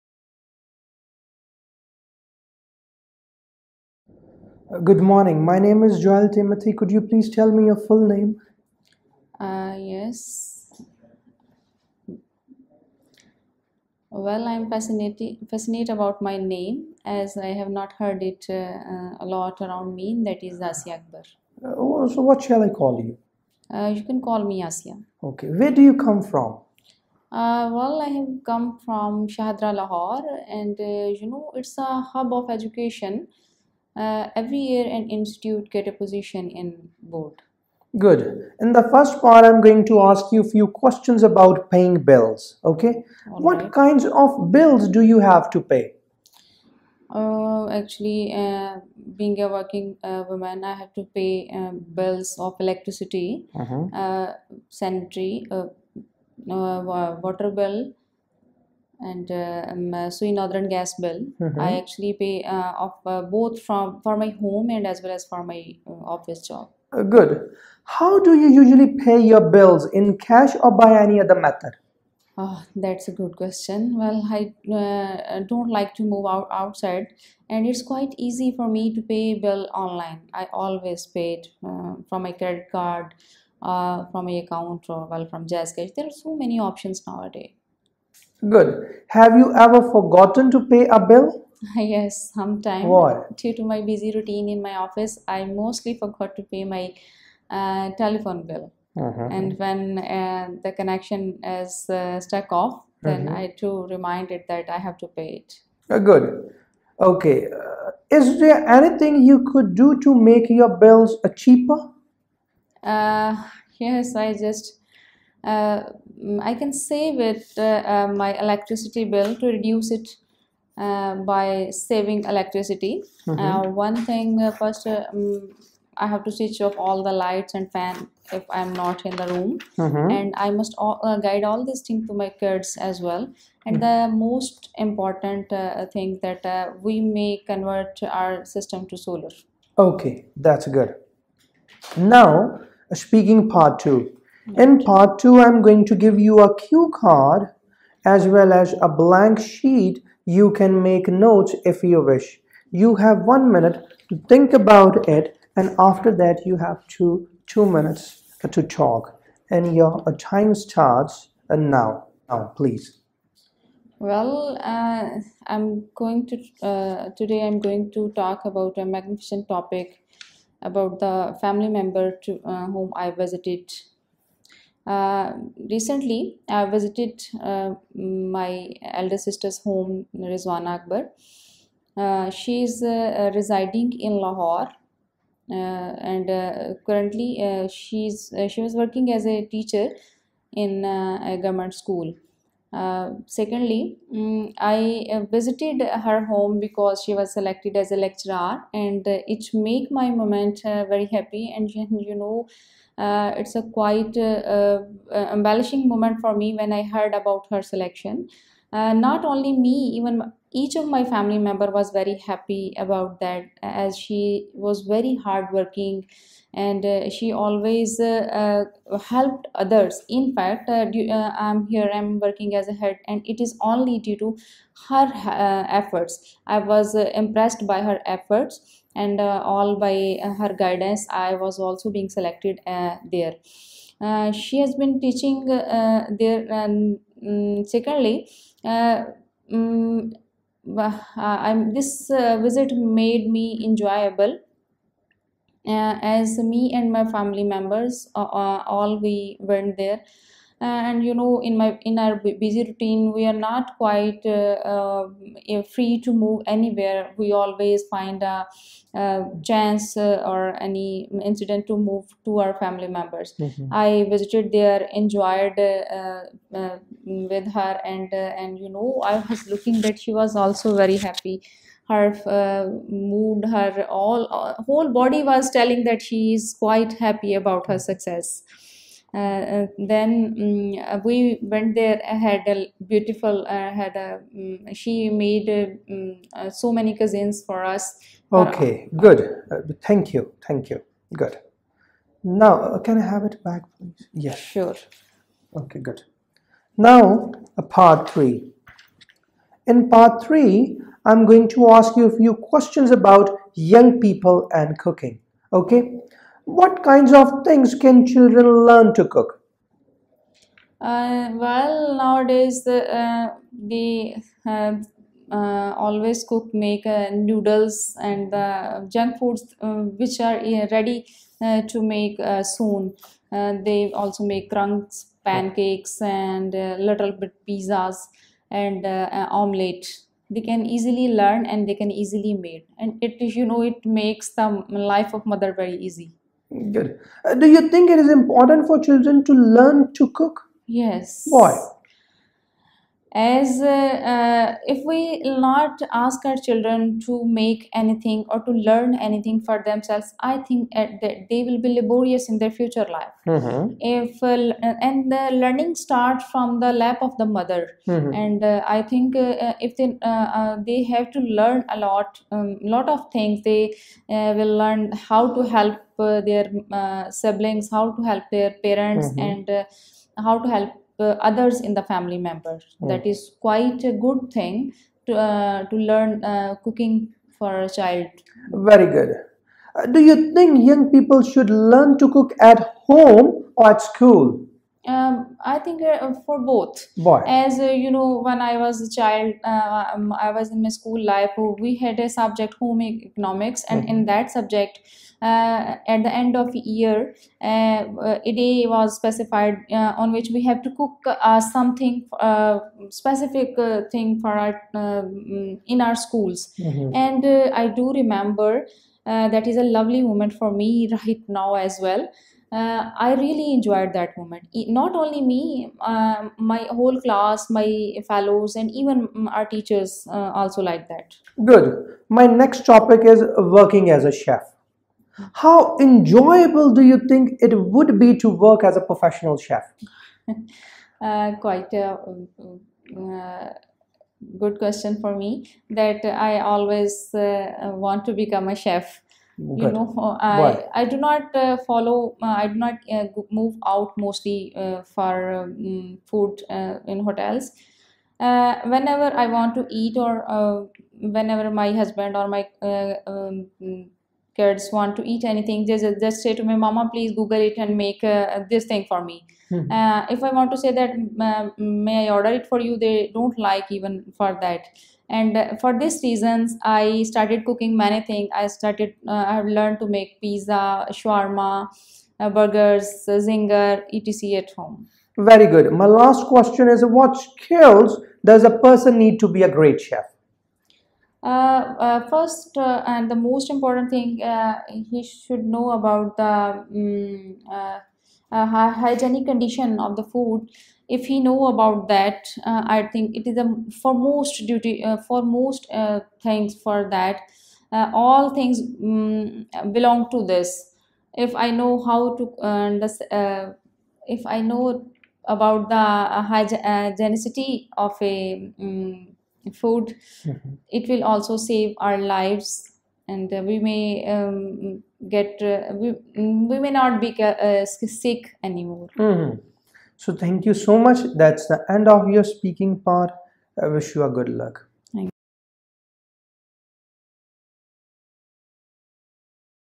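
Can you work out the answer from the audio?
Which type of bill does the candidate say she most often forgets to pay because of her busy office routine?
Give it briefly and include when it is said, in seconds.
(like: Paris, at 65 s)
Telephone bill, at 97 s.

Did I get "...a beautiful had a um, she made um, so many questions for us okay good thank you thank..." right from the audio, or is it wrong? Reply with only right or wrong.
wrong.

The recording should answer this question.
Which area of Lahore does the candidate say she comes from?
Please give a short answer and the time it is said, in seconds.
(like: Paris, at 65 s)
Shahadra, at 29 s.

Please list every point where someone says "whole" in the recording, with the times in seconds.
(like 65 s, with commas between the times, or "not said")
274 s, 416 s.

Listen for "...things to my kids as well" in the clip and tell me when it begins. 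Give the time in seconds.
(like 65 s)
131 s.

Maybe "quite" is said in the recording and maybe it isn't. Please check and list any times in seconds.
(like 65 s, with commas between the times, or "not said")
77 s, 203 s, 253 s, 276 s, 373 s, 431 s.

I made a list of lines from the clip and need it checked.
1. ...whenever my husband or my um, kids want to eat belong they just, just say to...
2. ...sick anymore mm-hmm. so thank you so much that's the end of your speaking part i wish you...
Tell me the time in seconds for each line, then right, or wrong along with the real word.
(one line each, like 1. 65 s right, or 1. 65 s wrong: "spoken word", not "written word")
1. 451 s wrong: "anything", not "belong"
2. 517 s right.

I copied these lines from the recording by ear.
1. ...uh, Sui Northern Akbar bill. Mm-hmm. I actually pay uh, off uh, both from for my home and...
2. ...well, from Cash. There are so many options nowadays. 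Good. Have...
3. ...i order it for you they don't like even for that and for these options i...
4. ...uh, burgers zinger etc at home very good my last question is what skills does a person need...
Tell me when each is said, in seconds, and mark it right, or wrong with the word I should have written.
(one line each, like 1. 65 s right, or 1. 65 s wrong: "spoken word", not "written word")
1. 59 s wrong: "Gas", not "Akbar"
2. 85 s right
3. 462 s wrong: "reasons", not "options"
4. 472 s right.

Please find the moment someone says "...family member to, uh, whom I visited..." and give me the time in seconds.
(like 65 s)
171 s.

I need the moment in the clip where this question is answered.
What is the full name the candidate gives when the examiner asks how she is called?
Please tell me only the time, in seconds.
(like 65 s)
20 s.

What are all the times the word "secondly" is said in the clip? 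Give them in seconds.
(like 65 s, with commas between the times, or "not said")
193 s, 237 s.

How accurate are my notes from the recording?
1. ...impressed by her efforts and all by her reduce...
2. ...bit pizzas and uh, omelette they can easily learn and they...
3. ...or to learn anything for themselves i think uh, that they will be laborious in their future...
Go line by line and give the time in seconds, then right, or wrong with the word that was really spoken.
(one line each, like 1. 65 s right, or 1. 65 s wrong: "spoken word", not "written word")
1. 226 s wrong: "guidance", not "reduce"
2. 327 s right
3. 348 s right.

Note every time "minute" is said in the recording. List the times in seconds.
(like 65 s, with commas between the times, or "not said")
153 s, 157 s.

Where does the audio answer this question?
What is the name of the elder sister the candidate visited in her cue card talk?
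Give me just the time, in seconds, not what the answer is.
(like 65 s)
180 s.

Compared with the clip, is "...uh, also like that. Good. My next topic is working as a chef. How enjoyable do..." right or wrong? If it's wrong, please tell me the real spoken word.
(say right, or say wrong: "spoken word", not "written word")
right.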